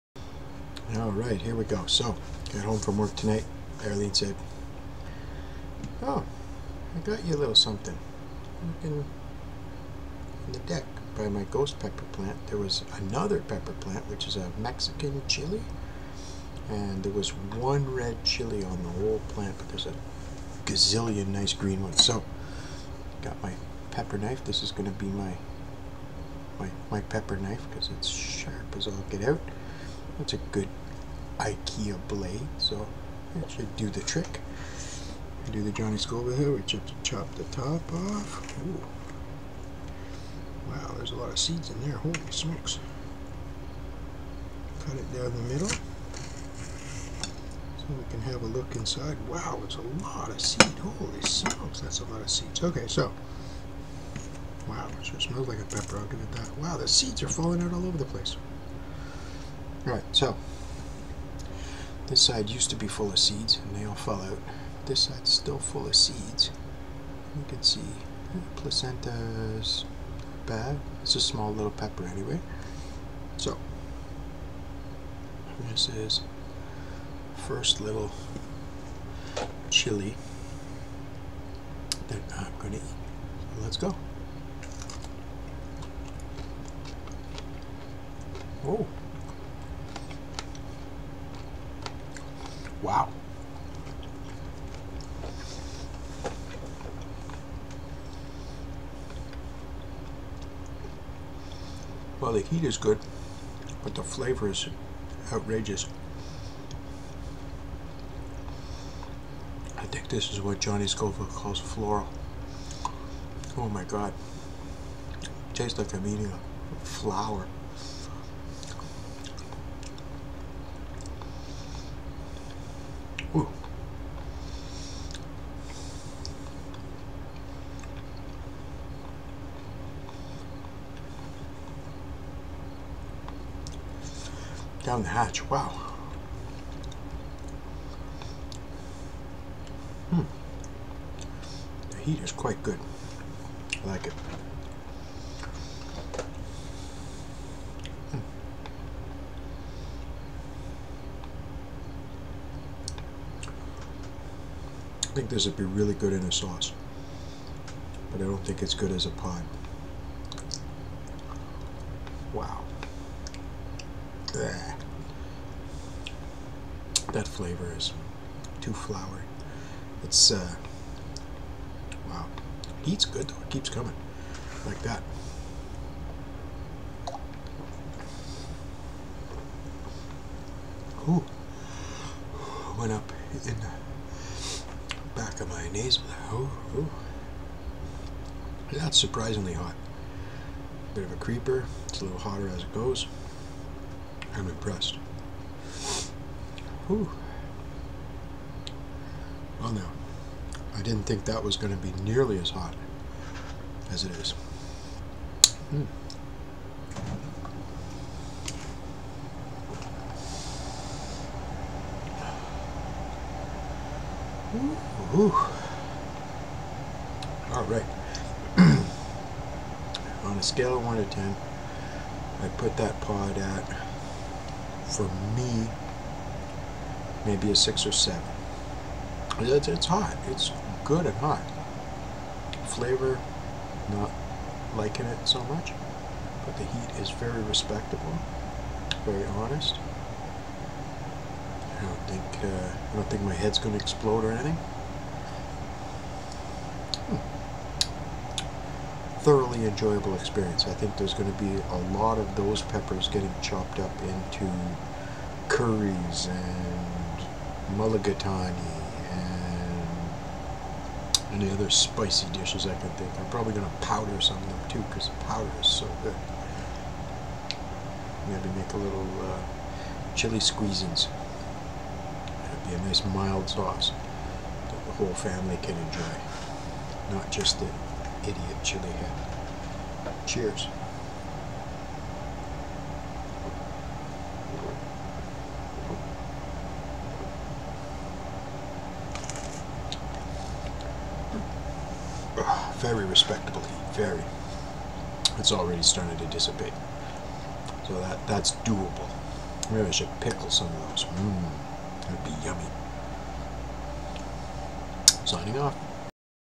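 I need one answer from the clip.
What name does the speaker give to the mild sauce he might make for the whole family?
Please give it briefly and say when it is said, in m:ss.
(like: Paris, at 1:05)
chili squeezins, at 4:30.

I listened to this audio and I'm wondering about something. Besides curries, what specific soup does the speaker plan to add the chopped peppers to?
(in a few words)
mulligatawny.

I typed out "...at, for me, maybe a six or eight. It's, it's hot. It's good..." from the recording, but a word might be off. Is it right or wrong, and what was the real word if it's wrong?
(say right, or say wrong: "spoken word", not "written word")
wrong: "seven", not "eight".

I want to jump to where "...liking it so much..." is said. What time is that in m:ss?
3:54.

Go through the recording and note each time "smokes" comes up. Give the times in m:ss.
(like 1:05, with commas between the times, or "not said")
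0:42, 0:51.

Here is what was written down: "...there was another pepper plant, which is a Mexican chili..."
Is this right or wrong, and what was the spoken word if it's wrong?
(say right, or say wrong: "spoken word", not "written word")
right.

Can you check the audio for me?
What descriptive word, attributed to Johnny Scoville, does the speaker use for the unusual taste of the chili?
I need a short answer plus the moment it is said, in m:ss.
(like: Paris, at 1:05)
floral, at 1:51.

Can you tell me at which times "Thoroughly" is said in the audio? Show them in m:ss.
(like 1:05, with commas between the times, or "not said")
4:09.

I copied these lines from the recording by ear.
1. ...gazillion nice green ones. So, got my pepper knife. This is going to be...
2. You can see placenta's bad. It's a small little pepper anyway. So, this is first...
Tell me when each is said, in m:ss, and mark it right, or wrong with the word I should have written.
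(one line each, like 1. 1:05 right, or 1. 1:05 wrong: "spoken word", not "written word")
1. 0:20 right
2. 1:07 right.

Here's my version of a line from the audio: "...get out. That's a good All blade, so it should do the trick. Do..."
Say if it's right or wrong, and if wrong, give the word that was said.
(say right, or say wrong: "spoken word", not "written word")
wrong: "IKEA", not "All".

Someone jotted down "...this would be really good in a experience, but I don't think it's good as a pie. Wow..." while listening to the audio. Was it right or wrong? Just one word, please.
wrong.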